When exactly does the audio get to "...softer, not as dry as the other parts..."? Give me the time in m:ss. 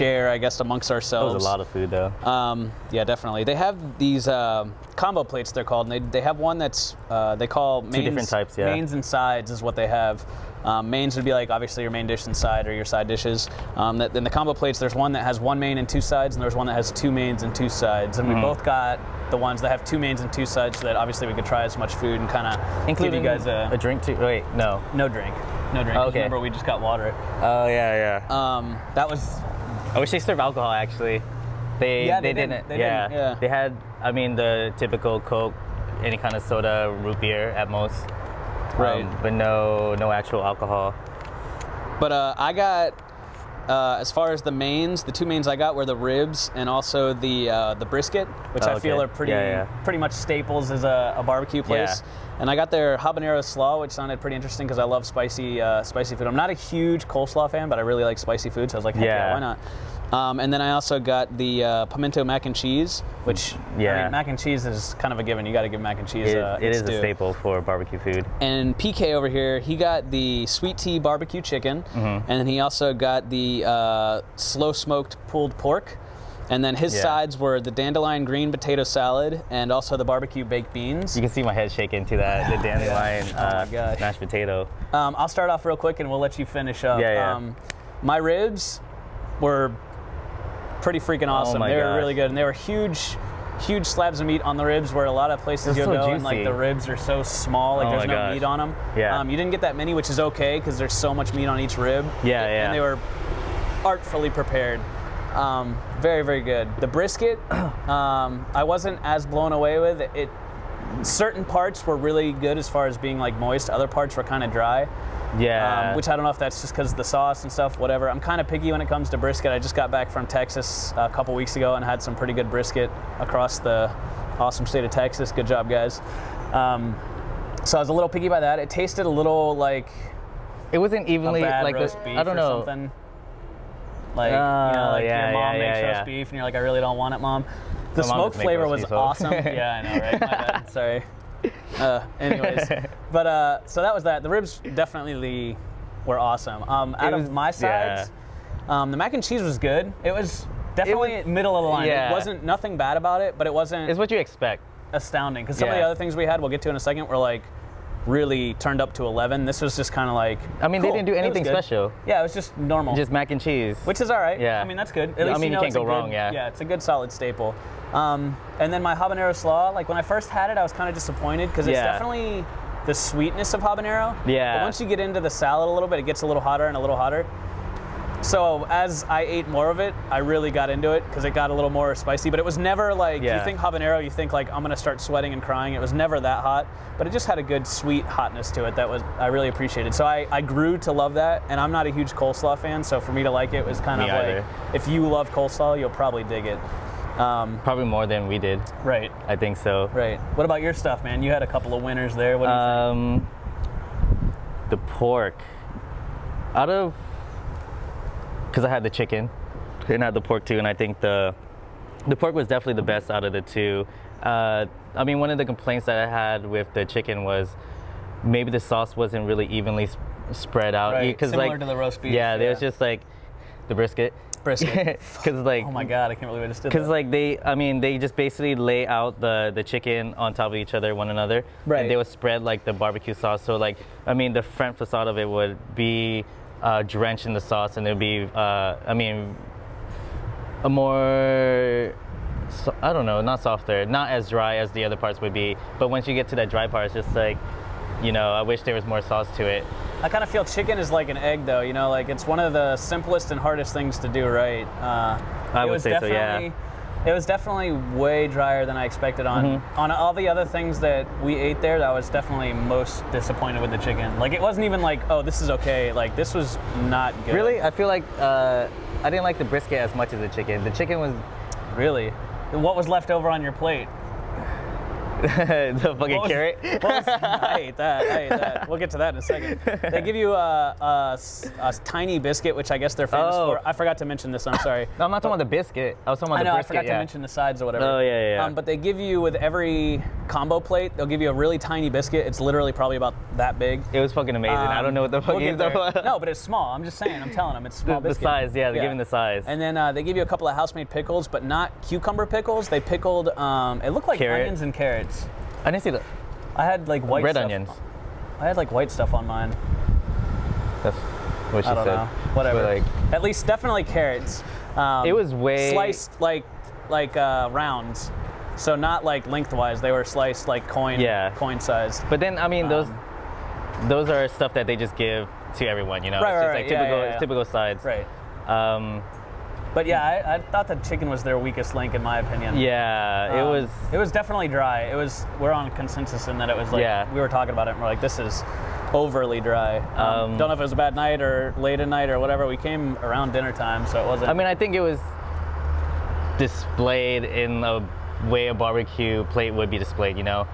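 4:03.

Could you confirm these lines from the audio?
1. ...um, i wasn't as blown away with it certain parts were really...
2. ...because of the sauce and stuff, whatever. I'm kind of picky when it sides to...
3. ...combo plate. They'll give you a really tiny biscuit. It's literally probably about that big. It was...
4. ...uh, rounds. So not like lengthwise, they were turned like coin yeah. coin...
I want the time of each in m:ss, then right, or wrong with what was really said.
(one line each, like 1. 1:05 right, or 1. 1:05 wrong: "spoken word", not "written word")
1. 1:47 right
2. 1:56 wrong: "comes", not "sides"
3. 4:50 right
4. 5:17 wrong: "sliced", not "turned".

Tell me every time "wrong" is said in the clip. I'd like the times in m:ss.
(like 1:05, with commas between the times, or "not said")
2:45.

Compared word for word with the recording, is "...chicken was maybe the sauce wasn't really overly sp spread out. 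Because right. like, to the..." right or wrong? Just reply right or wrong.
wrong.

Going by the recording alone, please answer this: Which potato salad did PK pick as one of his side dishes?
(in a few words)
Dandelion green potato salad.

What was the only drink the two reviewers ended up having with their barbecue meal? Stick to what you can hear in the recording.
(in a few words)
Water.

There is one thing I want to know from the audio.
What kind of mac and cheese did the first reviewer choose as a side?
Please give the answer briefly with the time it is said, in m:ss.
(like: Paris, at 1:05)
Pimento mac and cheese, at 1:01.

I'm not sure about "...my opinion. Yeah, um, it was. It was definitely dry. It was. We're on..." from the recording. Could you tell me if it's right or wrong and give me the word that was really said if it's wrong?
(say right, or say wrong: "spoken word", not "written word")
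right.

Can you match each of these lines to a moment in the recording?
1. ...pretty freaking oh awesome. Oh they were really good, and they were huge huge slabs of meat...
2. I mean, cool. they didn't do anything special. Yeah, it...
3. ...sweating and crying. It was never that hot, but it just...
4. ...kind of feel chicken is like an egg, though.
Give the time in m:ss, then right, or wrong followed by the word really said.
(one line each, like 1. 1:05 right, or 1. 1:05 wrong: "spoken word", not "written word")
1. 1:30 right
2. 2:40 right
3. 3:05 right
4. 4:10 right.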